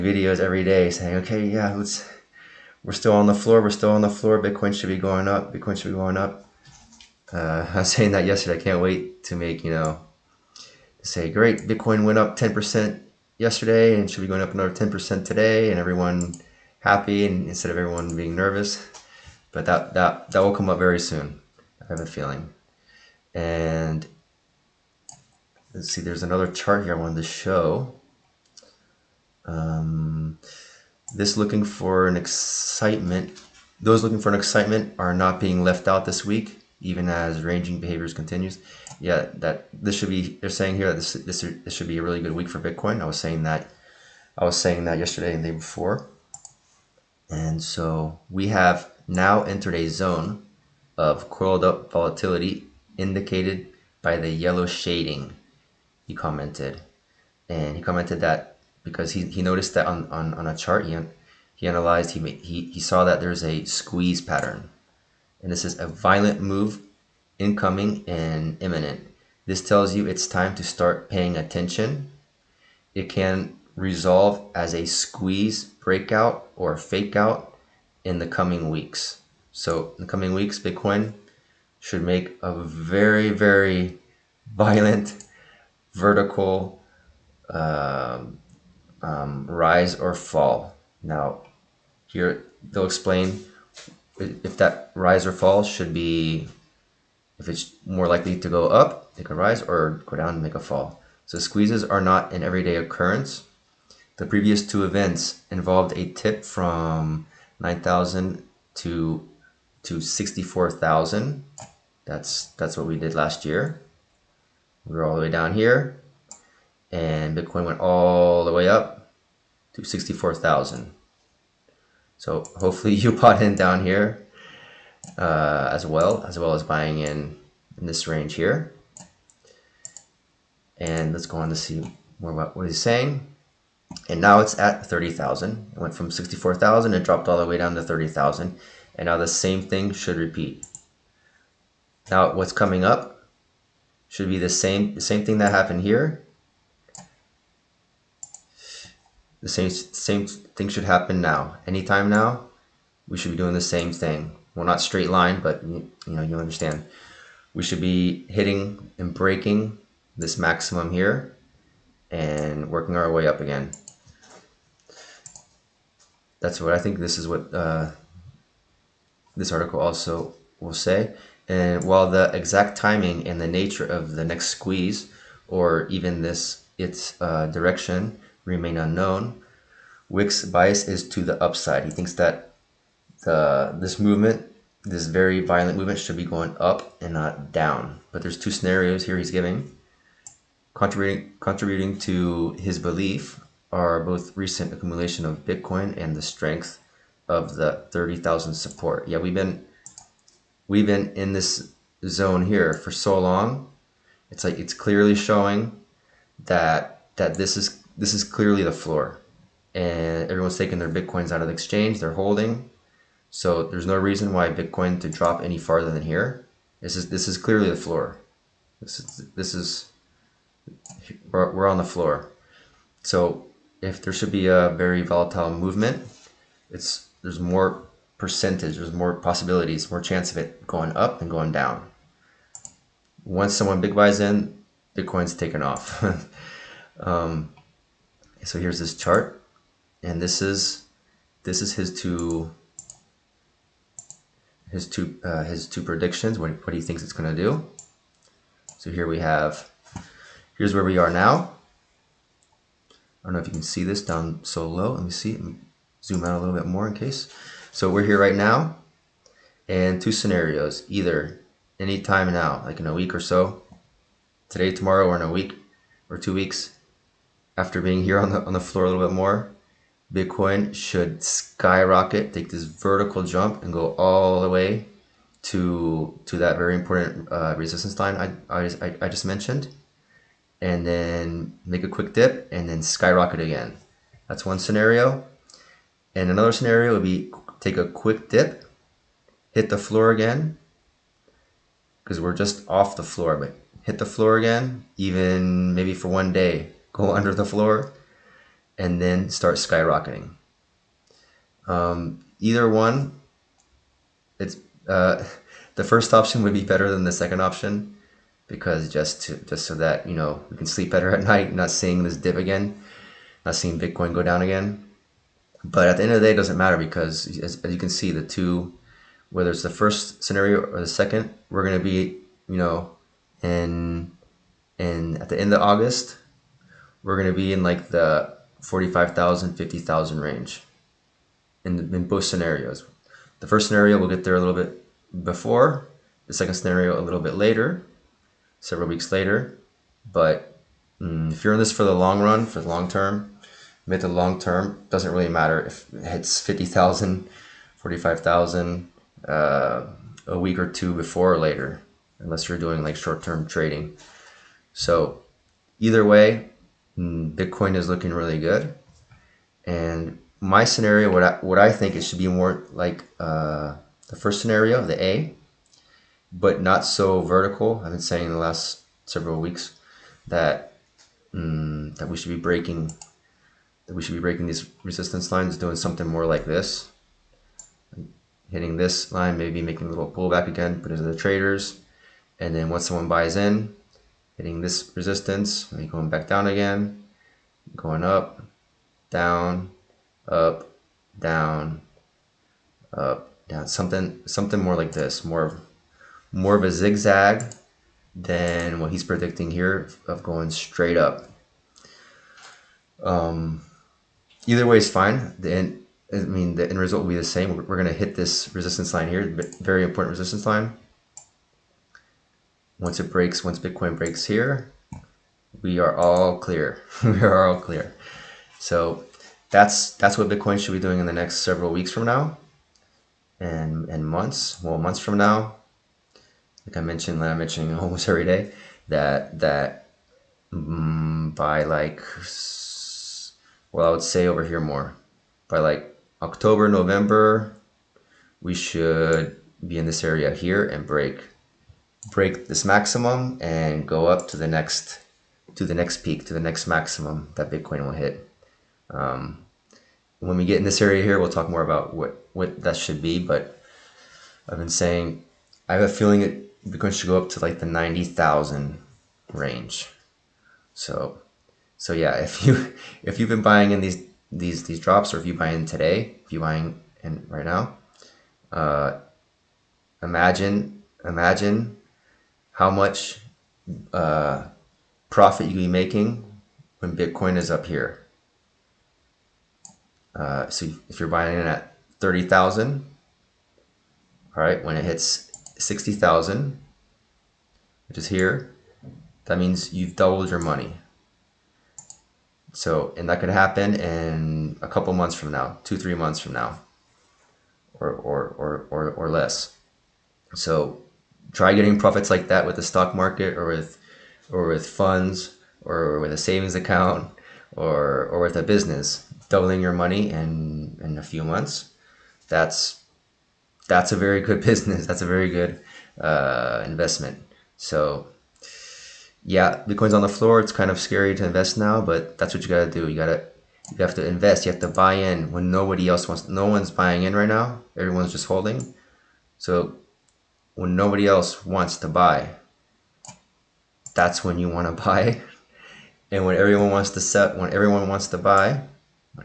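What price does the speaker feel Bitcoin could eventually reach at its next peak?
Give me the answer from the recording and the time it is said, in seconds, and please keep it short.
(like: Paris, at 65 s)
90,000, at 457 s.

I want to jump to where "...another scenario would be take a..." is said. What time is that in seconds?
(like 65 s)
286 s.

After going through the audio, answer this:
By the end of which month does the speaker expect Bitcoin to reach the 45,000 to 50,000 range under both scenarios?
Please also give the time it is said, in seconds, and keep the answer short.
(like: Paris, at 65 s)
August, at 325 s.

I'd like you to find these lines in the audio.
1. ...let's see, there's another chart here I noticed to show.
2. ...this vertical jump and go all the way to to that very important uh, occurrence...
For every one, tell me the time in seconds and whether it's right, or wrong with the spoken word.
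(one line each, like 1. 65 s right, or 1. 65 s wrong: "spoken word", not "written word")
1. 25 s wrong: "wanted", not "noticed"
2. 272 s wrong: "resistance", not "occurrence".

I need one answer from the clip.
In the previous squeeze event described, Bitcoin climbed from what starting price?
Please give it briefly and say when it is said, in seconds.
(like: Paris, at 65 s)
9,000, at 107 s.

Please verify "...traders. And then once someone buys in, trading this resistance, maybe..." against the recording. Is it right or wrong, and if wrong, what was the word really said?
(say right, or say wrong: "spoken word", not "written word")
wrong: "hitting", not "trading".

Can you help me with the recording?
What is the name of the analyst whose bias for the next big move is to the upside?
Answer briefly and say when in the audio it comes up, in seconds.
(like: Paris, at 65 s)
Wick, at 180 s.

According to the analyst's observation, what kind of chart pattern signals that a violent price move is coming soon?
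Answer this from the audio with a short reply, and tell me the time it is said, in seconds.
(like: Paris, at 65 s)
squeeze pattern, at 63 s.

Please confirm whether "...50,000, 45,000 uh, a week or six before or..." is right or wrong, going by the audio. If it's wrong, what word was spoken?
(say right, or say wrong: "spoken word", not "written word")
wrong: "two", not "six".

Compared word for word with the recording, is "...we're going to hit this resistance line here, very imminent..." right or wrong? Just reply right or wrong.
wrong.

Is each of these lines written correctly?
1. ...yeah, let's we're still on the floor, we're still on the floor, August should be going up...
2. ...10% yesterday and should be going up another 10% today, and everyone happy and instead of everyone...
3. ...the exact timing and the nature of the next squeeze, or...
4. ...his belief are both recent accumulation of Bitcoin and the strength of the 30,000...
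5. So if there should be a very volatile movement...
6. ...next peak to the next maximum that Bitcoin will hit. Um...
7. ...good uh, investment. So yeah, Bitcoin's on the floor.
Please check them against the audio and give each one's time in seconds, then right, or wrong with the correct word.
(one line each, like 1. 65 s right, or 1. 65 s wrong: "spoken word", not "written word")
1. 1 s wrong: "Bitcoin", not "August"
2. 12 s right
3. 172 s right
4. 192 s right
5. 223 s right
6. 445 s right
7. 515 s right.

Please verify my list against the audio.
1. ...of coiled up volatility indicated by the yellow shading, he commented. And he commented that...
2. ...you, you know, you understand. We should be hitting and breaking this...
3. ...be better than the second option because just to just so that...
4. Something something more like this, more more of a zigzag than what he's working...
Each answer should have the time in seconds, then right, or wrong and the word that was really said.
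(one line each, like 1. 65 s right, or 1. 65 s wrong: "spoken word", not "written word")
1. 50 s right
2. 155 s right
3. 306 s right
4. 393 s wrong: "predicting", not "working".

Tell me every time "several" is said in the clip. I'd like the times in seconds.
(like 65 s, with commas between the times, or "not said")
338 s, 369 s, 421 s.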